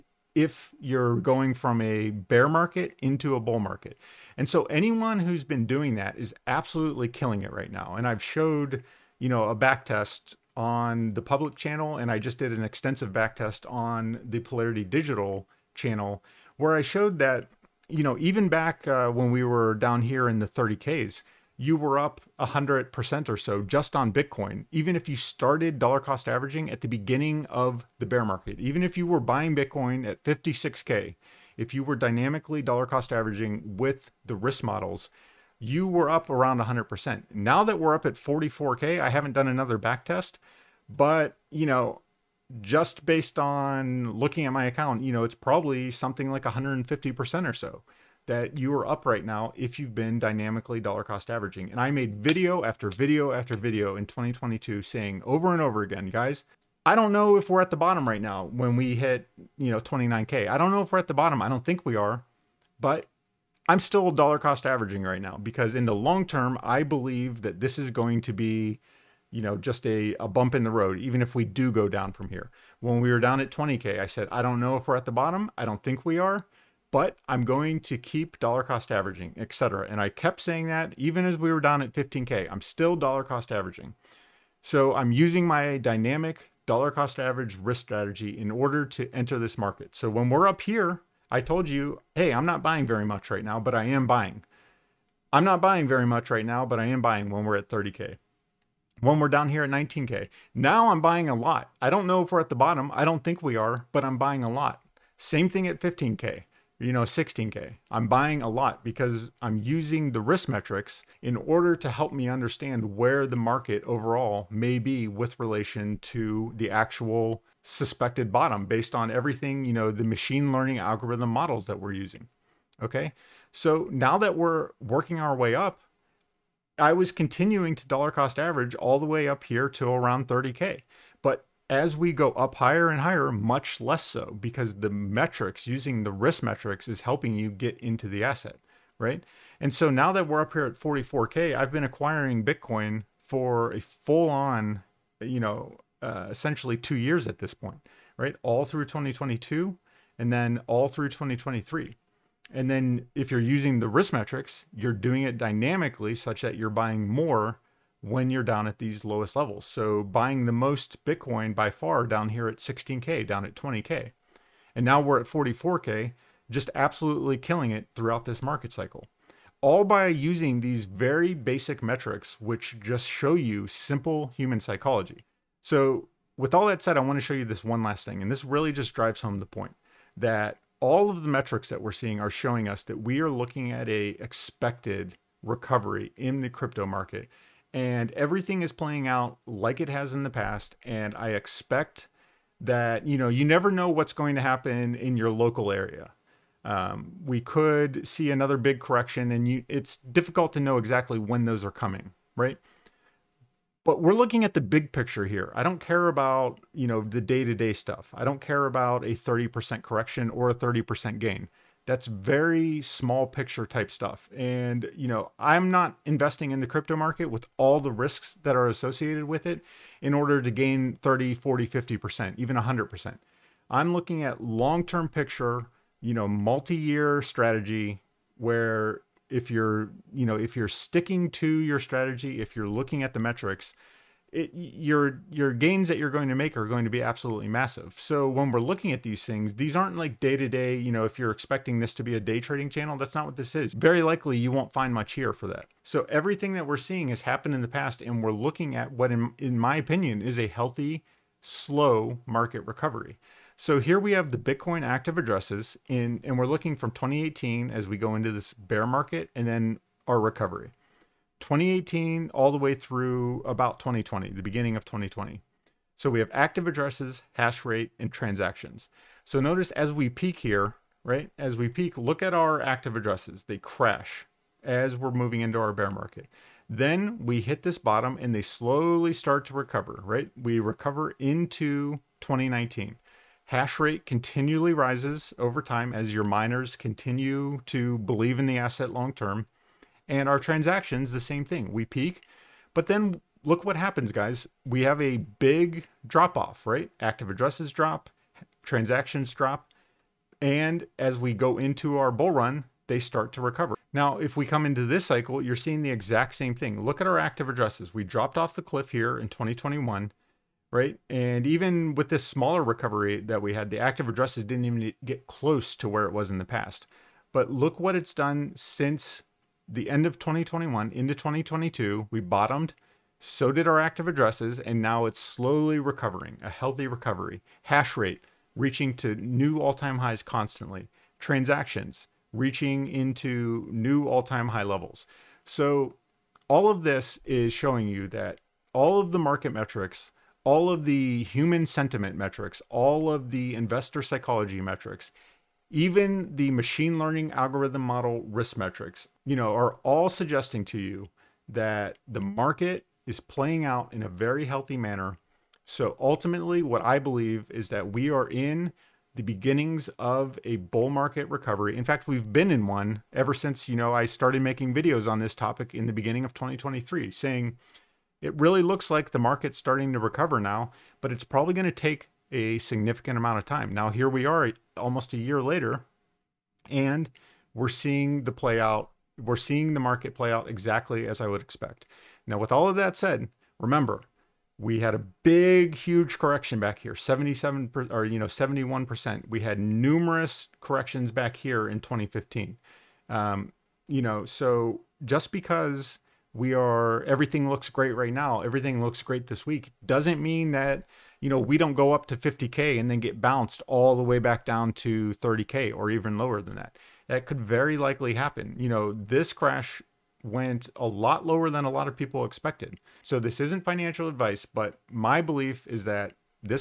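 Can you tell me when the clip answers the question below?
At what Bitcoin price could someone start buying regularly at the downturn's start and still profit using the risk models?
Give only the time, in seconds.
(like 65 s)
30 s.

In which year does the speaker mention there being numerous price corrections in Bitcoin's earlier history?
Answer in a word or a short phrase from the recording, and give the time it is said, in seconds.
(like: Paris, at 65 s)
2015, at 391 s.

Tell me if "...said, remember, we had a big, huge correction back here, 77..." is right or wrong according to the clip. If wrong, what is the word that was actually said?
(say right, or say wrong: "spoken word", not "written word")
right.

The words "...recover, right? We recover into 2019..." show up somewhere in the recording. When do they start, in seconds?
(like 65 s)
279 s.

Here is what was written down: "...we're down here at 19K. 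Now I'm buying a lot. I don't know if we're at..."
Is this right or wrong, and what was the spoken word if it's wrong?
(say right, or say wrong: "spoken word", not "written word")
right.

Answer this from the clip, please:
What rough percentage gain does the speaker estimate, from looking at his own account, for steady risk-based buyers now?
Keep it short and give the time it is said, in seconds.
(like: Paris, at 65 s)
150%, at 46 s.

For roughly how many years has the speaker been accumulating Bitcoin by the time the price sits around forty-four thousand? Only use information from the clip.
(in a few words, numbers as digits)
2 years.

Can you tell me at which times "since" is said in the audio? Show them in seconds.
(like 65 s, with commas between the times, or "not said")
318 s, 363 s.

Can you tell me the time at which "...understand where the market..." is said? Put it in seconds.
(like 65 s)
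112 s.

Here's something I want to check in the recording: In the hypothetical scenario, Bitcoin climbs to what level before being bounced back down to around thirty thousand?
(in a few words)
50K.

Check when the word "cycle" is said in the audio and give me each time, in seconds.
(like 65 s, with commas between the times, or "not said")
168 s, 305 s.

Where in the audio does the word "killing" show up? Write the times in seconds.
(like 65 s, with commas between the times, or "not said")
7 s, 167 s.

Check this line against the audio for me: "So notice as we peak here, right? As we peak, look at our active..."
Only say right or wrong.
right.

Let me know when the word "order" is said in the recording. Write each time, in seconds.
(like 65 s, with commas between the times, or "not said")
88 s, 111 s, 220 s.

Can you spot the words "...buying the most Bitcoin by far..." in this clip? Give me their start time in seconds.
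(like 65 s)
160 s.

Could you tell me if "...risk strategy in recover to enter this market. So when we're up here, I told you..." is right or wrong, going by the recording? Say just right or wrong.
wrong.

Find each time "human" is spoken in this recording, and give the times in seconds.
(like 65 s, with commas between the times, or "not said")
174 s, 341 s.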